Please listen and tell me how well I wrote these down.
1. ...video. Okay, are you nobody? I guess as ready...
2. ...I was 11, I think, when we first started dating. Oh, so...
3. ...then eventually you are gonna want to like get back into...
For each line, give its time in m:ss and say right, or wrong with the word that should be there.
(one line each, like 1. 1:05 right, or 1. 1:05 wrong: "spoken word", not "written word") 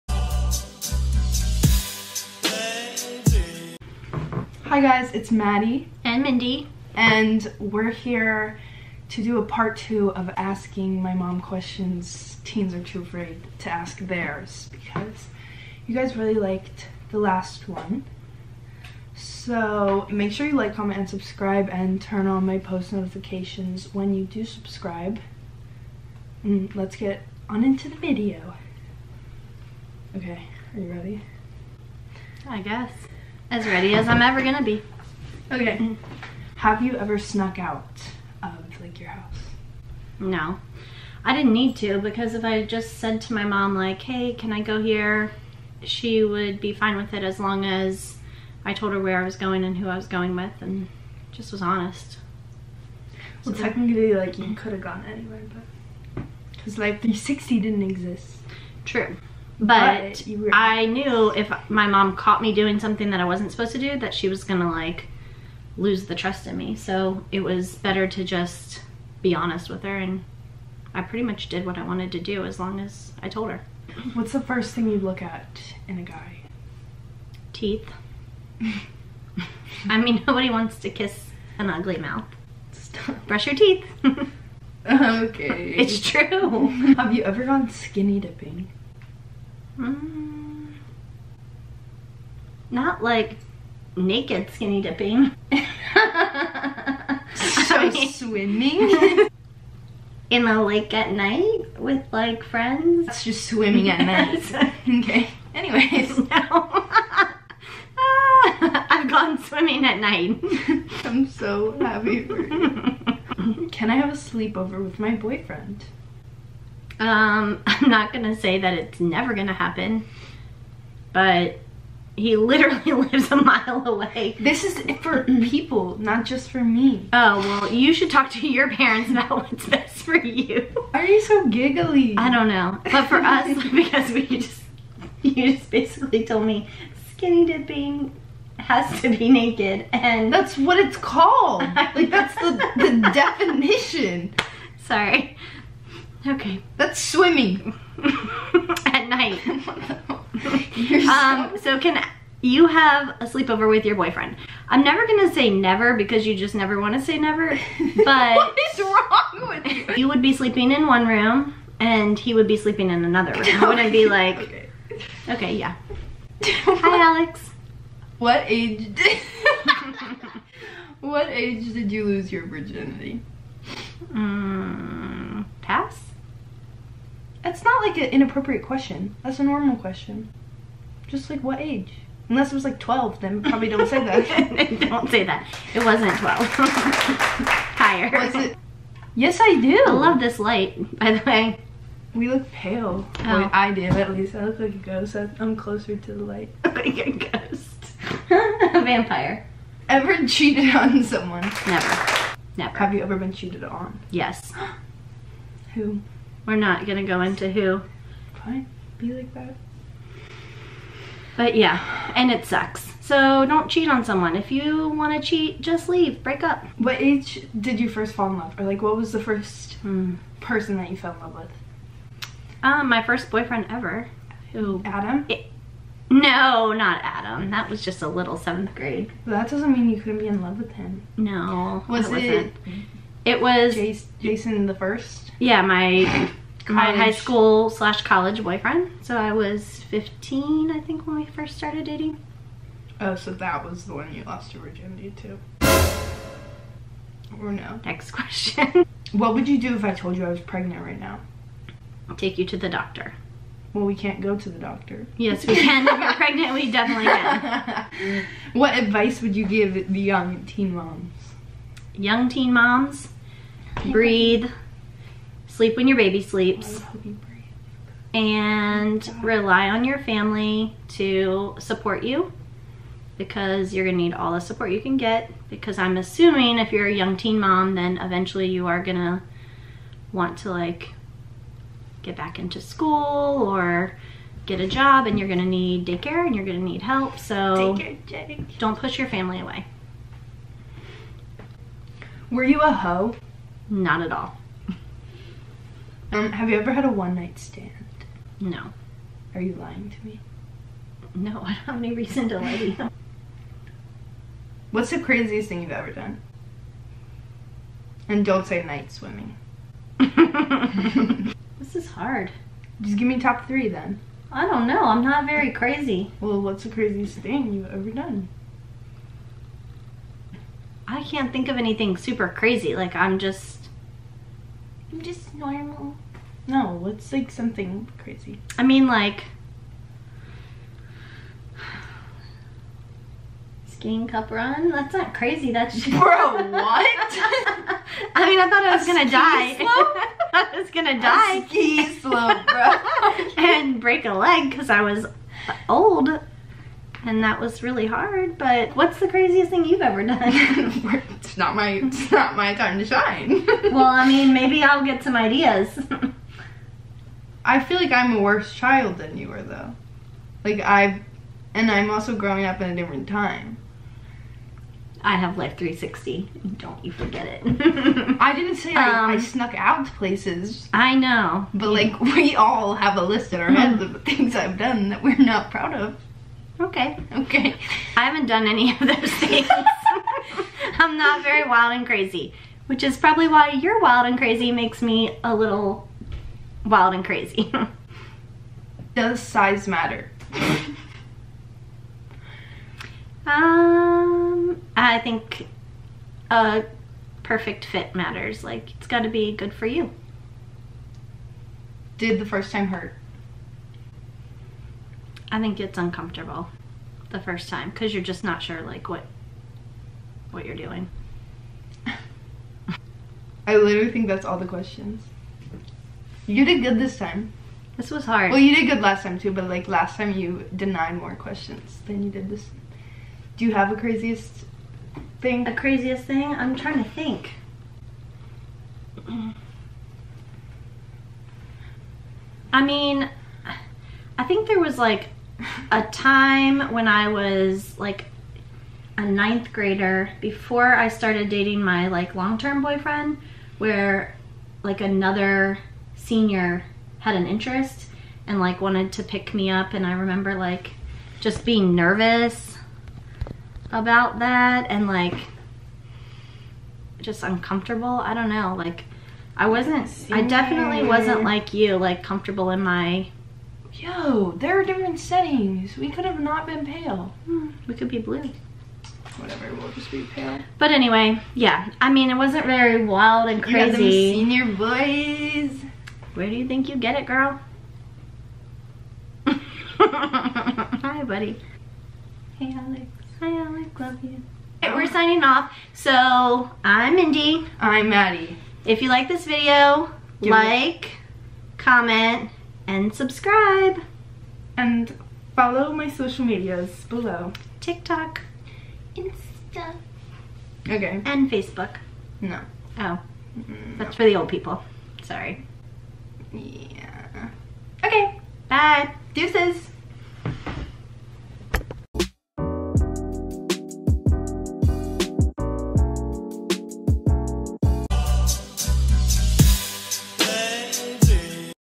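1. 0:27 wrong: "ready", not "nobody"
2. 3:59 wrong: "15", not "11"
3. 4:37 right.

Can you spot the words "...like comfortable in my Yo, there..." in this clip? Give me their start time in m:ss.
7:41.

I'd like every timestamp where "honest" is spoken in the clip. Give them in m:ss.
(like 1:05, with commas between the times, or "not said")
0:51, 1:09.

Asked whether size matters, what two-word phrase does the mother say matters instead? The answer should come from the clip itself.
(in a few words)
Perfect fit.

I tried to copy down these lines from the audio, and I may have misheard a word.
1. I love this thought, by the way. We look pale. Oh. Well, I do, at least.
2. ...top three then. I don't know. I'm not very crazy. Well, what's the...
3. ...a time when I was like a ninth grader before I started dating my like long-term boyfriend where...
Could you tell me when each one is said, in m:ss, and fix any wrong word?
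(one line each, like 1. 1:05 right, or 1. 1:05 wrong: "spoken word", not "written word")
1. 3:09 wrong: "light", not "thought"
2. 5:13 right
3. 7:15 right.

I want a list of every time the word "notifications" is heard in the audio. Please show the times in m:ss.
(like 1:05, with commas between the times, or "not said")
0:22.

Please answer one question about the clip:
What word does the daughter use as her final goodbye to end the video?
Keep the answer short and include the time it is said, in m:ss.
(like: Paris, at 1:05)
Deuces, at 8:29.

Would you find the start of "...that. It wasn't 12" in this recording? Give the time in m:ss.
3:05.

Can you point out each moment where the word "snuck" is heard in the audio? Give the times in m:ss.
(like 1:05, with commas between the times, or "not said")
0:37, 6:09.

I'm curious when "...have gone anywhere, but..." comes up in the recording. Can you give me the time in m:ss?
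0:54.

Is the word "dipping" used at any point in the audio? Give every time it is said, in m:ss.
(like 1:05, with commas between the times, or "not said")
1:28, 1:34, 2:17.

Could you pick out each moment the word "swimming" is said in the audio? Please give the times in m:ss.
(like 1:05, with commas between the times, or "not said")
1:37, 1:43, 1:49, 2:27, 5:08.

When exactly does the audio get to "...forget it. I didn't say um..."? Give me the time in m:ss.
6:06.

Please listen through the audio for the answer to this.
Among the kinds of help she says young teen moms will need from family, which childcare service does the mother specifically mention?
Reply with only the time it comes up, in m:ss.
4:45.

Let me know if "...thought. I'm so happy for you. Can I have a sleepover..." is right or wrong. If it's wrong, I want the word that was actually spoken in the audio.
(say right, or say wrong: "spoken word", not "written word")
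wrong: "night", not "thought".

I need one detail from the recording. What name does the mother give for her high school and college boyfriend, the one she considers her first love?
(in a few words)
Jason.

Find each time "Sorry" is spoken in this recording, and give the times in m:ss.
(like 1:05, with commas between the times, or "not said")
2:24, 8:25.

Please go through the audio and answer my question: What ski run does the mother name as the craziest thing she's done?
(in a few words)
Cup run.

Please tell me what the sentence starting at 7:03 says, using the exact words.
Do you have a craziest thing?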